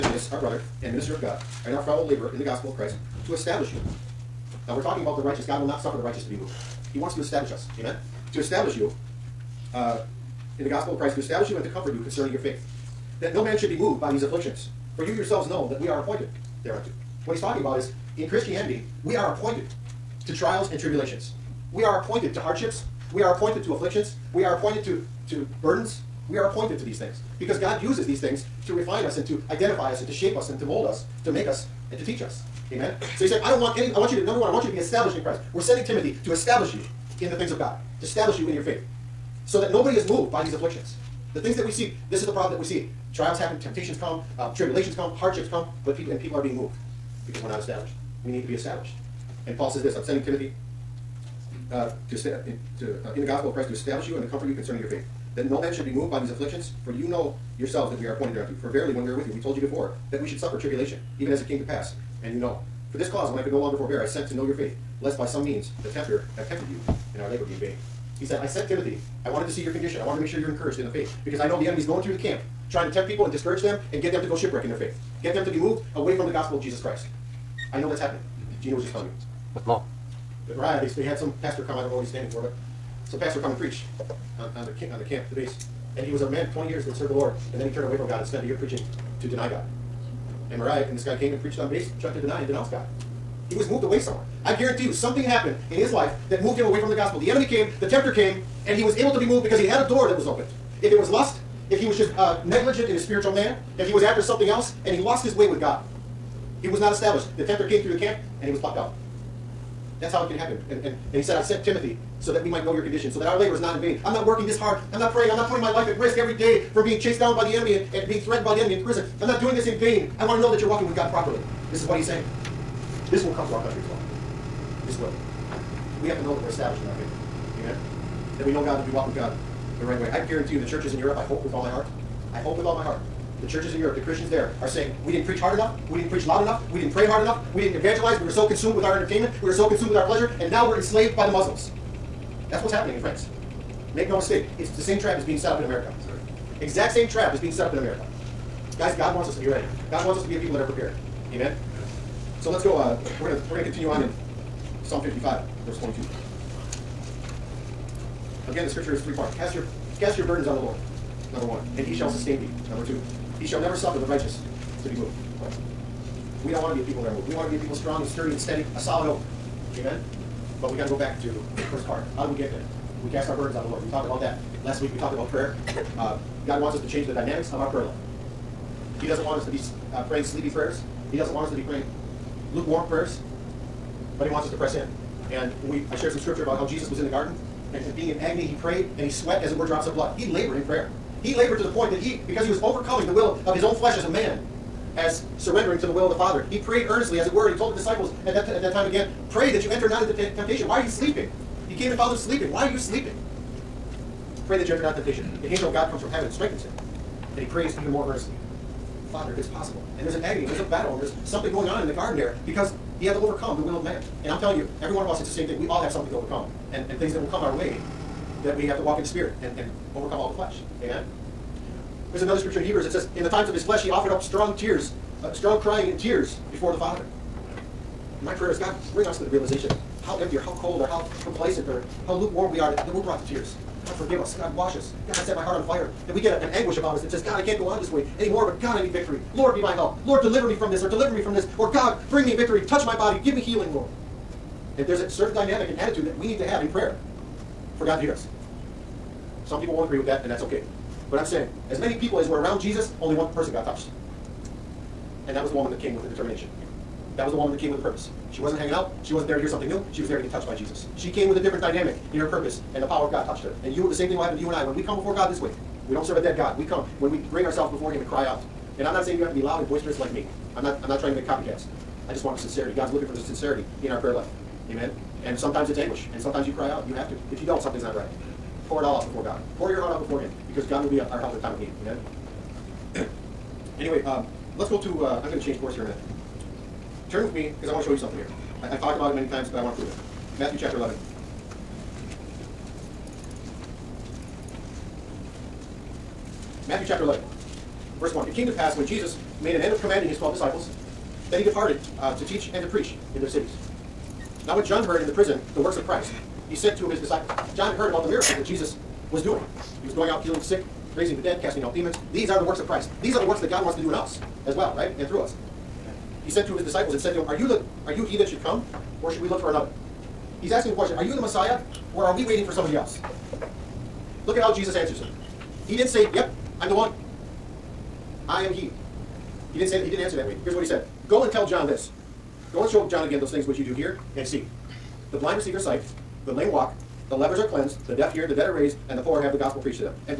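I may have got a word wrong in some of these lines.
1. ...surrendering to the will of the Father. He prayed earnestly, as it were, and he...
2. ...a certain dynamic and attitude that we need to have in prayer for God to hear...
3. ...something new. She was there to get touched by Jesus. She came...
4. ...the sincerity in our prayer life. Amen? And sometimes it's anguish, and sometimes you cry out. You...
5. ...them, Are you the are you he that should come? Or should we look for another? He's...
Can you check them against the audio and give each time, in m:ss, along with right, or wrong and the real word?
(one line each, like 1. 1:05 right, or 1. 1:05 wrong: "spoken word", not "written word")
1. 3:15 right
2. 4:04 right
3. 4:19 right
4. 4:33 right
5. 5:17 right.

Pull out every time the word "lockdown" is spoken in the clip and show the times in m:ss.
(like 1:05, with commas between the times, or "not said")
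not said.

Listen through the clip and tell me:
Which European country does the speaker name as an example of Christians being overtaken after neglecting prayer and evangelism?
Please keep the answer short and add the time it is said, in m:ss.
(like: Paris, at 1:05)
France, at 2:22.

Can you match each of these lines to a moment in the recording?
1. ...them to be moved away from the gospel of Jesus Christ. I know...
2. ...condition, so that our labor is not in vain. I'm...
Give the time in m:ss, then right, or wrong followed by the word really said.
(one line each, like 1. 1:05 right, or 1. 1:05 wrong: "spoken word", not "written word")
1. 1:15 right
2. 1:52 right.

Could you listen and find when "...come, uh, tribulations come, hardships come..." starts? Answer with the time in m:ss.
0:44.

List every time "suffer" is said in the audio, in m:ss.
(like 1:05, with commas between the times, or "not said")
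0:05, 1:00, 2:43.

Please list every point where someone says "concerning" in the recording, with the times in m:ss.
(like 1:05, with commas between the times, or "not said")
0:12, 0:54.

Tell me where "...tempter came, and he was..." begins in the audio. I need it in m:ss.
1:37.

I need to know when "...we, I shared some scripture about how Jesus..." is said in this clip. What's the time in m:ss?
3:05.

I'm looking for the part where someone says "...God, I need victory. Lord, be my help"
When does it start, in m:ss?
3:58.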